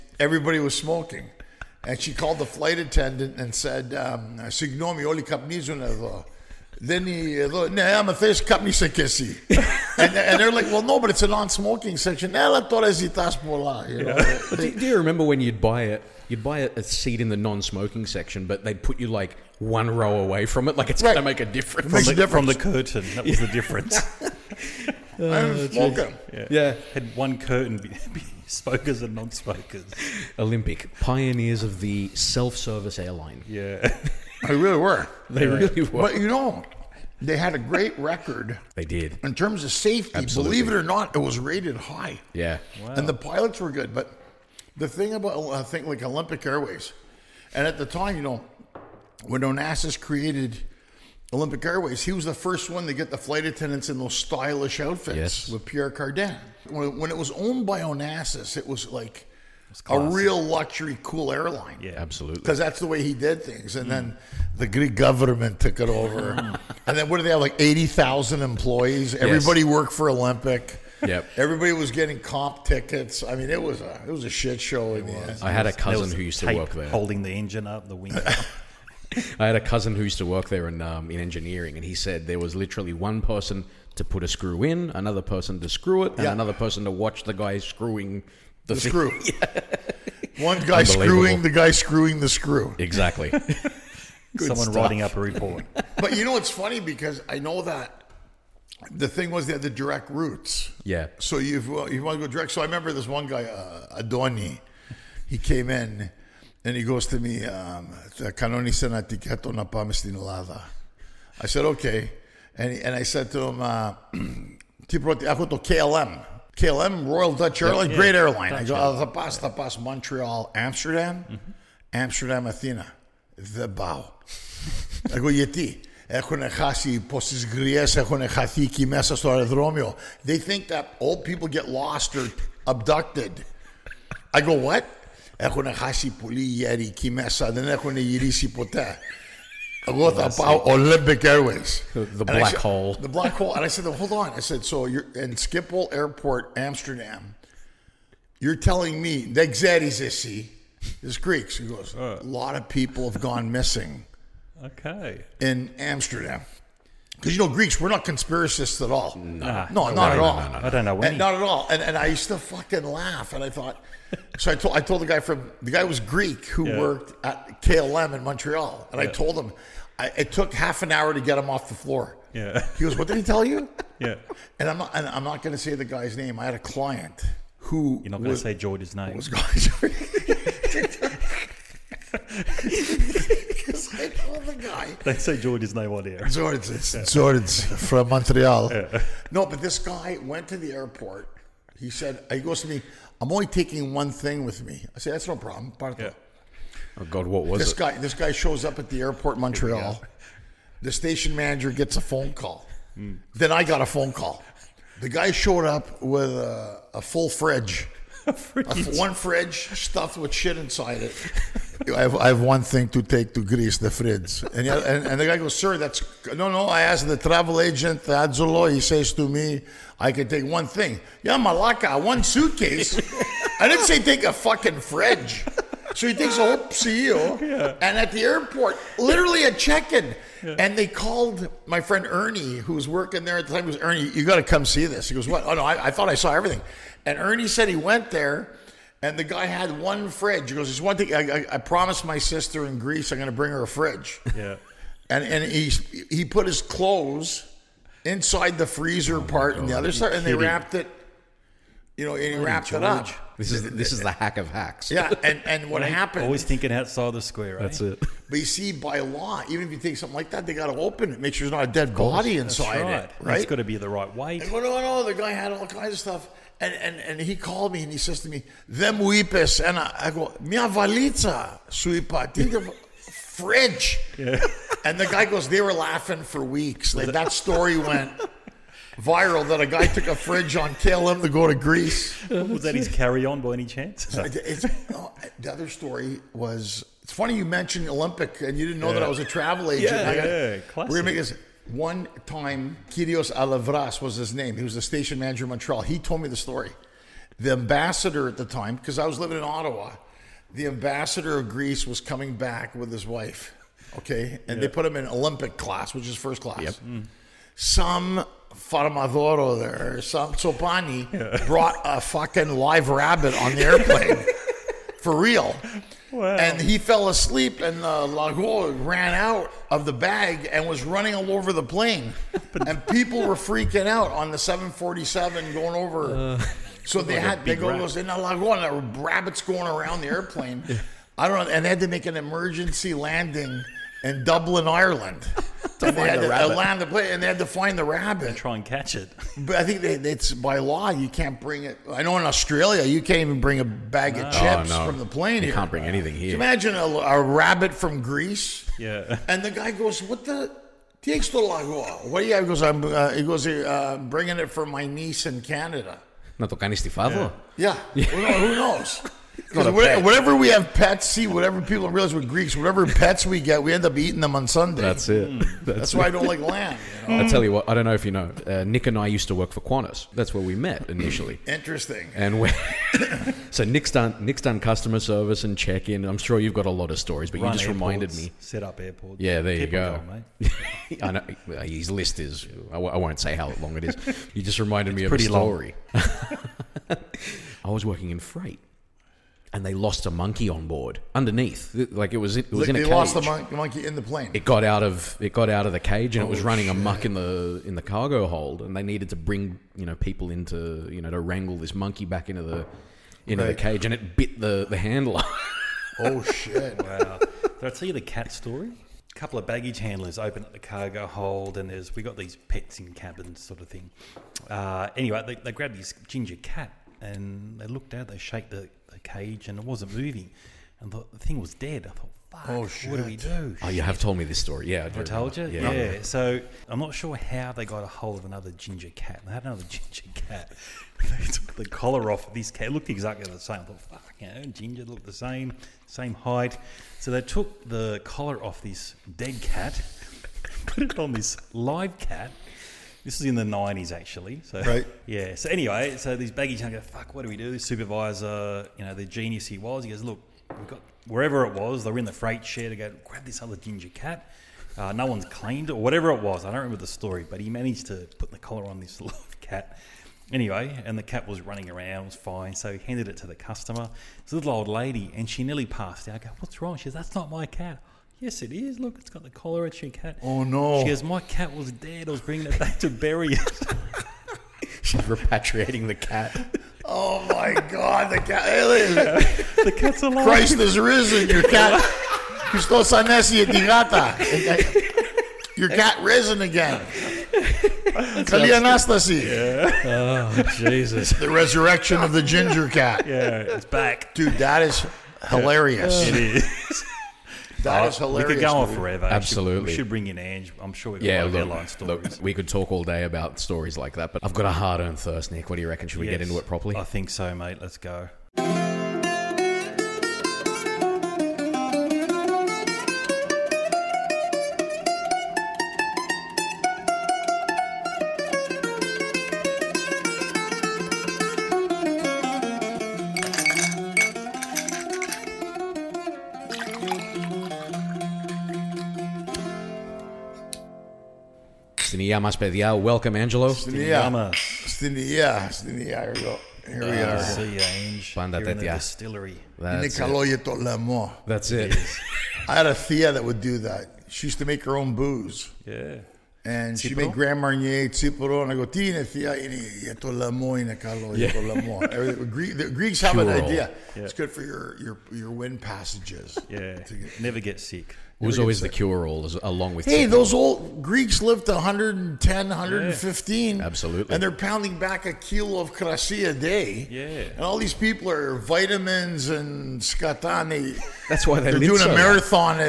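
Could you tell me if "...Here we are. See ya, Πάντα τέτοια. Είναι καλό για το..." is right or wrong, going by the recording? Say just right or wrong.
right.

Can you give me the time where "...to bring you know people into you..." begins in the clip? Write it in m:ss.
6:39.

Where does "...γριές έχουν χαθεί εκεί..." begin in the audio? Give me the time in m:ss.
2:07.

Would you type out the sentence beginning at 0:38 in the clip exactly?
They did in terms of safety.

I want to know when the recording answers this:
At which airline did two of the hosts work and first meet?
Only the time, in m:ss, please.
6:09.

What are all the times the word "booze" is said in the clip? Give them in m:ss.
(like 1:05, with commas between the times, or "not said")
9:04.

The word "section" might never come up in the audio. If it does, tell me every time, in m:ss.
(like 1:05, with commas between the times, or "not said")
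0:11, 0:18.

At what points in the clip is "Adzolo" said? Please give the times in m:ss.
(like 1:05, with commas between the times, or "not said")
3:38.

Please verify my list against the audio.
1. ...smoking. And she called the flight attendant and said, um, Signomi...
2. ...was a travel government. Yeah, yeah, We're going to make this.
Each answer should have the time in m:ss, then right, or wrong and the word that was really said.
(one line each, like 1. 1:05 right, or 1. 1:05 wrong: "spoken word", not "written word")
1. 0:00 right
2. 4:49 wrong: "agent", not "government".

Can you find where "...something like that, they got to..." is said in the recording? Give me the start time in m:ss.
4:19.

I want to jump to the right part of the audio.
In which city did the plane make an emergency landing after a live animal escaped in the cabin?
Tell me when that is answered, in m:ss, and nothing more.
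5:34.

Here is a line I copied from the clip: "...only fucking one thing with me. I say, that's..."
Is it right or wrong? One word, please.
wrong.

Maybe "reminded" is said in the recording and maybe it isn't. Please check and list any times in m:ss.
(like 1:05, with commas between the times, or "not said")
6:17, 6:24.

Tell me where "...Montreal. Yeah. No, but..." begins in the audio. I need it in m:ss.
3:08.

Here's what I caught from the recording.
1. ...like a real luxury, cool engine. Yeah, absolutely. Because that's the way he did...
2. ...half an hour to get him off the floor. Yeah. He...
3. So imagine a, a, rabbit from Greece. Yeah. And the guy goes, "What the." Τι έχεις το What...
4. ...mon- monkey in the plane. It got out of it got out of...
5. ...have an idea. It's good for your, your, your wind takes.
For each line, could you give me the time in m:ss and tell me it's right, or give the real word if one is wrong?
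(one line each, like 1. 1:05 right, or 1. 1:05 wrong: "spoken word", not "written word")
1. 0:58 wrong: "airline", not "engine"
2. 2:50 right
3. 5:46 right
4. 6:33 right
5. 9:13 wrong: "passages", not "takes".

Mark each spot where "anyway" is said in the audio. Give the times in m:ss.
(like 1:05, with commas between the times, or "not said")
6:54, 7:25, 7:40.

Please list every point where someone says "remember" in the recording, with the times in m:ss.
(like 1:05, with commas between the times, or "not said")
0:14, 1:42, 7:36.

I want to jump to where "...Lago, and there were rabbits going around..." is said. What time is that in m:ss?
5:28.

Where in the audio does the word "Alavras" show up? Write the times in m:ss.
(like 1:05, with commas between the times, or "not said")
4:53.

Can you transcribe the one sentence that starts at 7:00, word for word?
And the, the thing was dead.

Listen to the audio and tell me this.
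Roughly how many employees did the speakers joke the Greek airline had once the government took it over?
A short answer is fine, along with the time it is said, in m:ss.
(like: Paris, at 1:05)
80,000, at 1:07.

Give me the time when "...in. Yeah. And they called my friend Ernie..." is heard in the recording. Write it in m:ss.
3:49.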